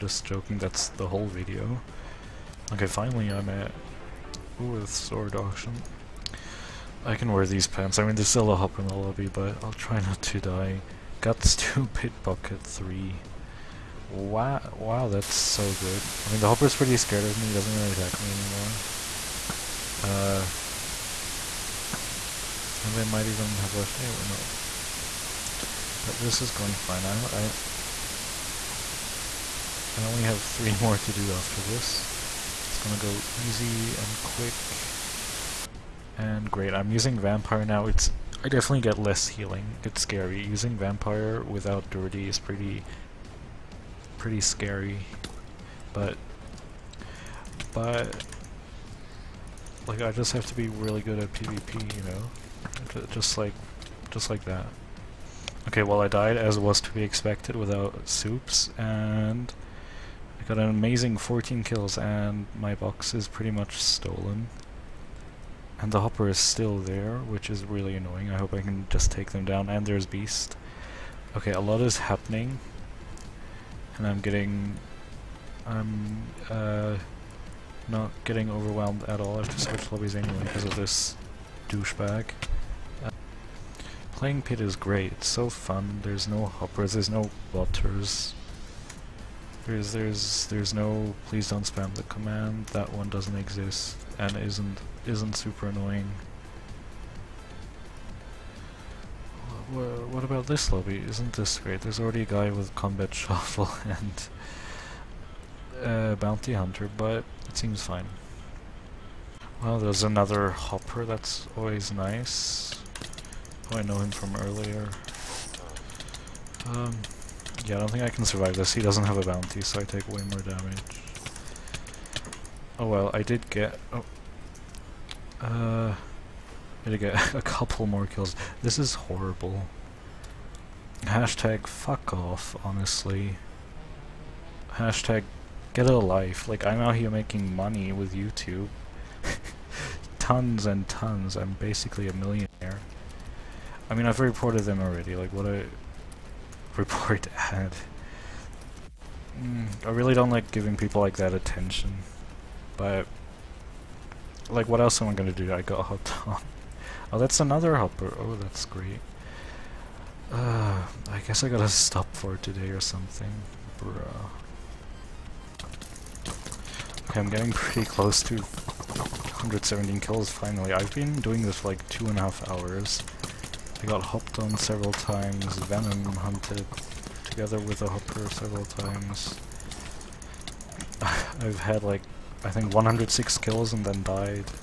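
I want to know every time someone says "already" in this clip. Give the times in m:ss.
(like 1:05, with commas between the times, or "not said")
1:41, 2:24.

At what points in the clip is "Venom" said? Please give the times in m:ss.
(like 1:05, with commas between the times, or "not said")
2:55.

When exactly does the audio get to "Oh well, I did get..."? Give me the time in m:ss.
2:02.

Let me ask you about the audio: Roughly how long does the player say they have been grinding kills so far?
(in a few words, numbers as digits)
two and a half hours.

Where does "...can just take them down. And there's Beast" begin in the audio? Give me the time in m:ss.
1:08.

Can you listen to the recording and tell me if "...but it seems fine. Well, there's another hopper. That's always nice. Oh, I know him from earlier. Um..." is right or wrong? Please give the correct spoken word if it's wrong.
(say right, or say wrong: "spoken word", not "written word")
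right.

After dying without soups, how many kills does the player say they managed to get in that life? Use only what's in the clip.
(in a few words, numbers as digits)
14.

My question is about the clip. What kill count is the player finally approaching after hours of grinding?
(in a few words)
117.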